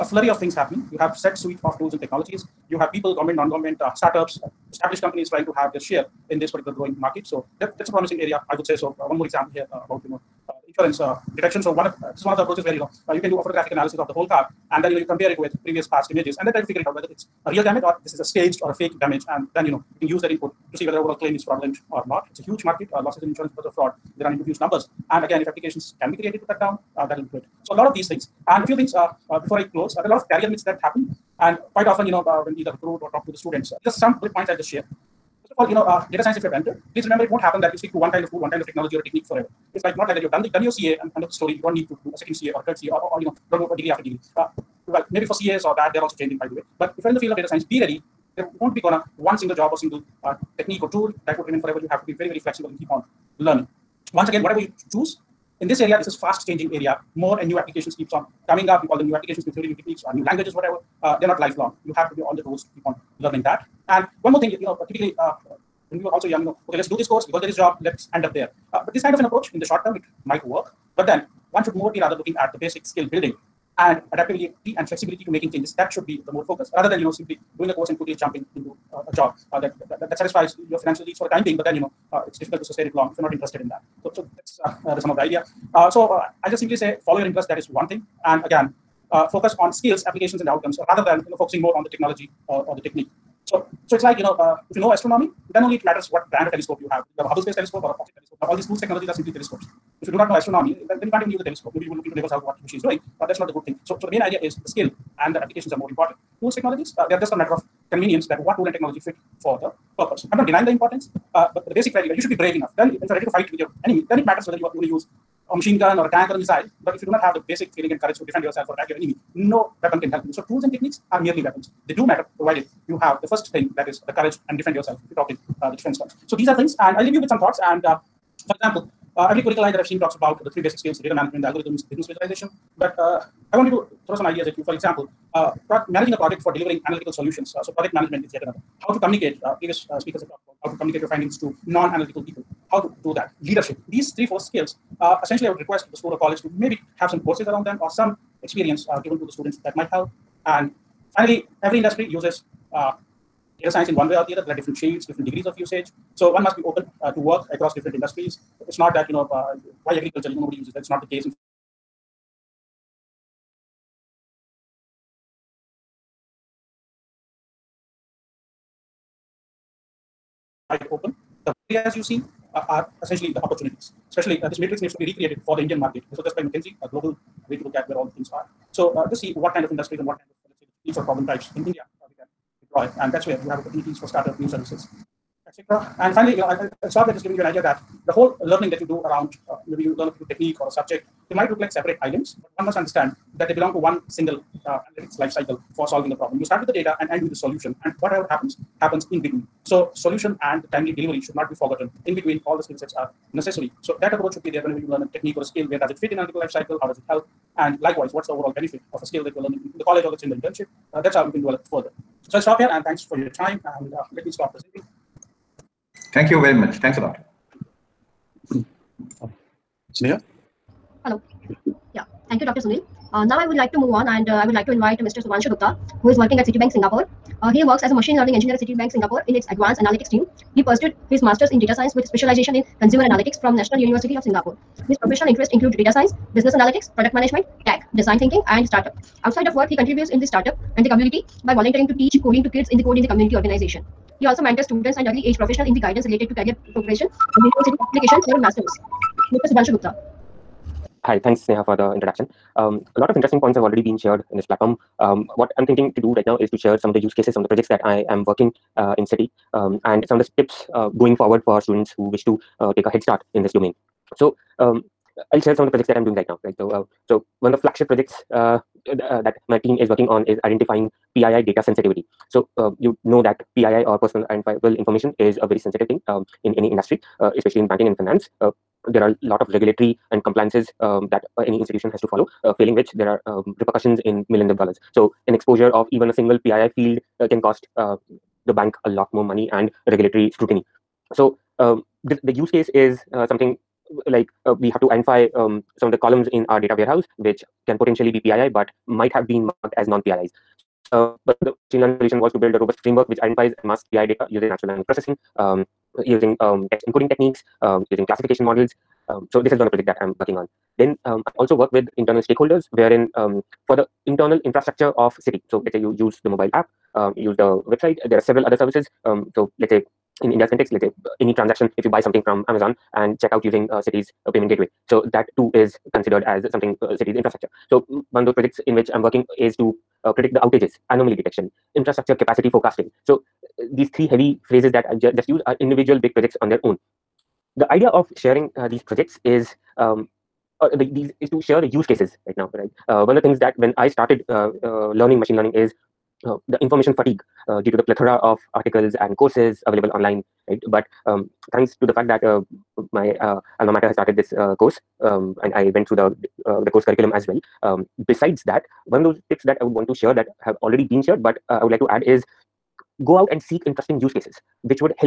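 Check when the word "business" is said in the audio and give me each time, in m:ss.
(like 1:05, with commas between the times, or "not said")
2:11, 3:56.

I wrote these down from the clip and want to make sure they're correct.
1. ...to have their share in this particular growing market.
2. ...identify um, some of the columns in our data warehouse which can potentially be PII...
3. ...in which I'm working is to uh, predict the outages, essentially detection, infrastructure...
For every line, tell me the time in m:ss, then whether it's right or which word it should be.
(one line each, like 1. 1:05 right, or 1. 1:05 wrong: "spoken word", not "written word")
1. 0:05 right
2. 4:54 right
3. 5:28 wrong: "anomaly", not "essentially".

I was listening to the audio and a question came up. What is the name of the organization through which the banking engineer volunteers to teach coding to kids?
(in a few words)
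Code in the Community.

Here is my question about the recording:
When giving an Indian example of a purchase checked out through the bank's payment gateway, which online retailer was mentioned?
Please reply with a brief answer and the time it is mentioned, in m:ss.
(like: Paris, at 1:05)
Amazon, at 5:22.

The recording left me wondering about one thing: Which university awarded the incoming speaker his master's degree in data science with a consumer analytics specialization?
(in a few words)
National University of Singapore.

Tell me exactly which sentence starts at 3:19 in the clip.
So solution and timely delivery should not be forgotten.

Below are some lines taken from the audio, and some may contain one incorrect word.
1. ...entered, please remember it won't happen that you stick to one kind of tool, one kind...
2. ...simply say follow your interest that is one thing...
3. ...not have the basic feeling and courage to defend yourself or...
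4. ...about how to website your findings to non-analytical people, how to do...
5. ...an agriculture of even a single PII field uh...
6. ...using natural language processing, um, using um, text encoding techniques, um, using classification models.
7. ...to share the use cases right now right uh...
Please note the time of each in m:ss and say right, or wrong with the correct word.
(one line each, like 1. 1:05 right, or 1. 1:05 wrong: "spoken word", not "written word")
1. 0:36 right
2. 1:26 right
3. 1:57 right
4. 2:20 wrong: "communicate", not "website"
5. 4:45 wrong: "exposure", not "agriculture"
6. 5:04 right
7. 5:41 right.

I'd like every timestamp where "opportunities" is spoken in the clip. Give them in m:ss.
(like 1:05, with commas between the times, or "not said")
2:53, 3:03.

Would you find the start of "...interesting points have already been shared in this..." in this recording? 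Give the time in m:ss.
4:13.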